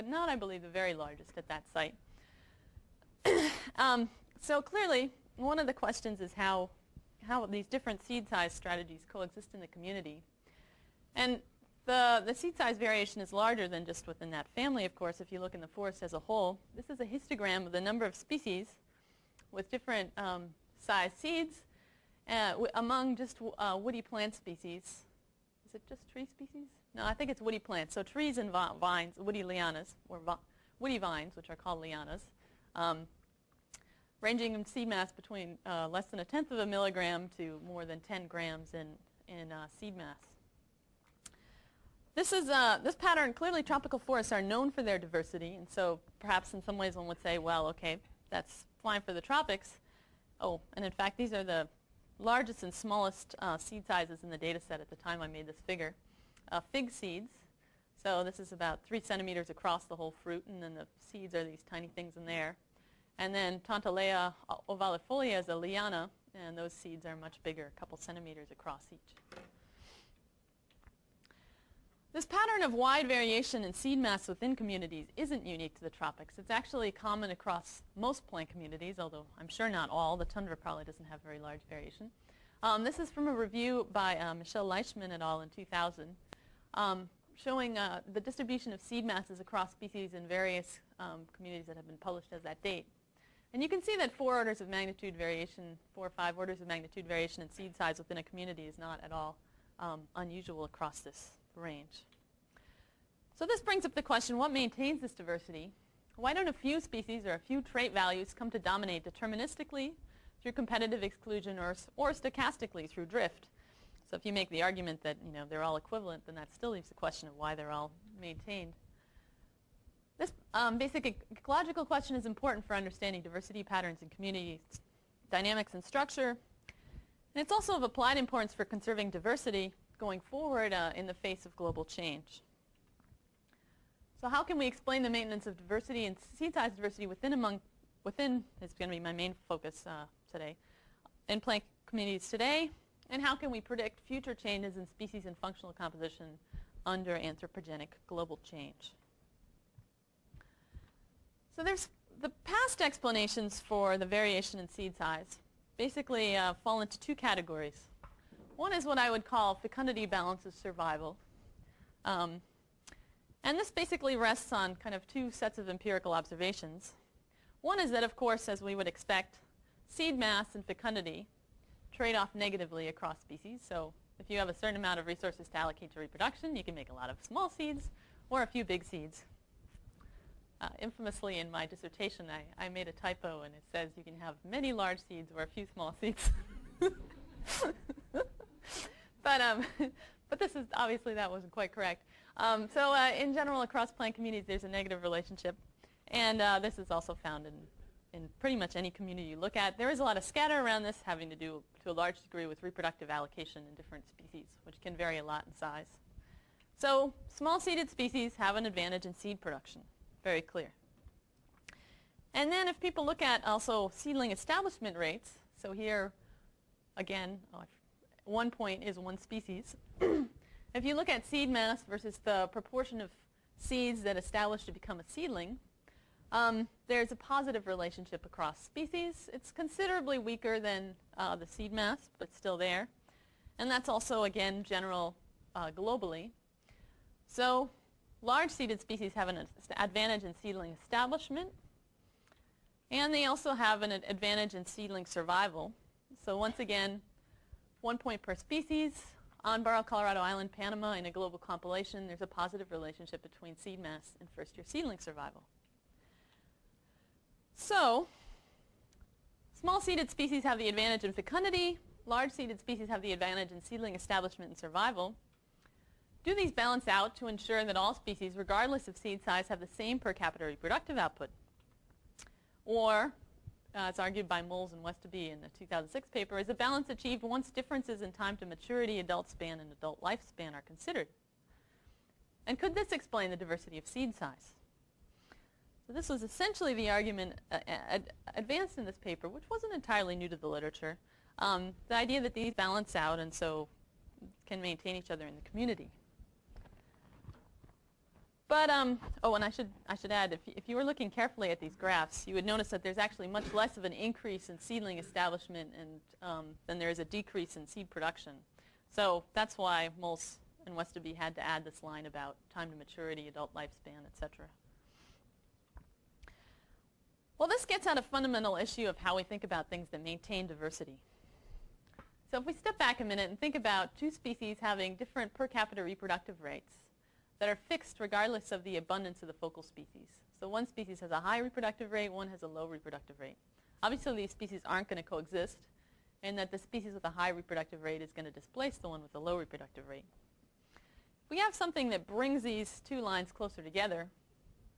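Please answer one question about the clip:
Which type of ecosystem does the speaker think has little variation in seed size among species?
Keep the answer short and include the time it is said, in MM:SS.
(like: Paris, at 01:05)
Tundra, at 01:20.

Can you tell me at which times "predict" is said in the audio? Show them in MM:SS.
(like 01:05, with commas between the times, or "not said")
02:23.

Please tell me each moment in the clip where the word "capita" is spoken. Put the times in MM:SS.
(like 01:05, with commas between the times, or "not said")
04:30, 05:25.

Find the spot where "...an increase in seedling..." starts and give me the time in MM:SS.
05:03.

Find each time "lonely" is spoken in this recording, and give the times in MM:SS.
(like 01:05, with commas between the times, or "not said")
not said.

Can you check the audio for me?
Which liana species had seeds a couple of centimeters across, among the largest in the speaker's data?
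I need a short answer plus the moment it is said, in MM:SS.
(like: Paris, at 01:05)
Tontelea ovalifolia, at 01:03.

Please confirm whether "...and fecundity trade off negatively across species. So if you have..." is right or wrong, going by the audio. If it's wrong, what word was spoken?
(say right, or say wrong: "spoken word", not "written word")
right.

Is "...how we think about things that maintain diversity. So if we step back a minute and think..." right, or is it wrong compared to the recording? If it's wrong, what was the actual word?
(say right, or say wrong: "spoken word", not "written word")
right.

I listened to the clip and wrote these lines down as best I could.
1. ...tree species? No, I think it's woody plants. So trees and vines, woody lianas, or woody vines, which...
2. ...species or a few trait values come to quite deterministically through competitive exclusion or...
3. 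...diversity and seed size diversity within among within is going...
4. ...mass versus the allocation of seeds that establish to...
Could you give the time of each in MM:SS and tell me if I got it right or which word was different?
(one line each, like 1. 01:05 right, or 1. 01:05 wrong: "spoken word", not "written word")
1. 00:26 right
2. 01:46 wrong: "dominate", not "quite"
3. 02:15 right
4. 03:41 wrong: "proportion", not "allocation".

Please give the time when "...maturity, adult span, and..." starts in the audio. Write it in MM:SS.
04:38.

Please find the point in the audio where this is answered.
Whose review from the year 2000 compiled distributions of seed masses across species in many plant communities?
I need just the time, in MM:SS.
01:24.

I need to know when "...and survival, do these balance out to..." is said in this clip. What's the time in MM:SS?
04:24.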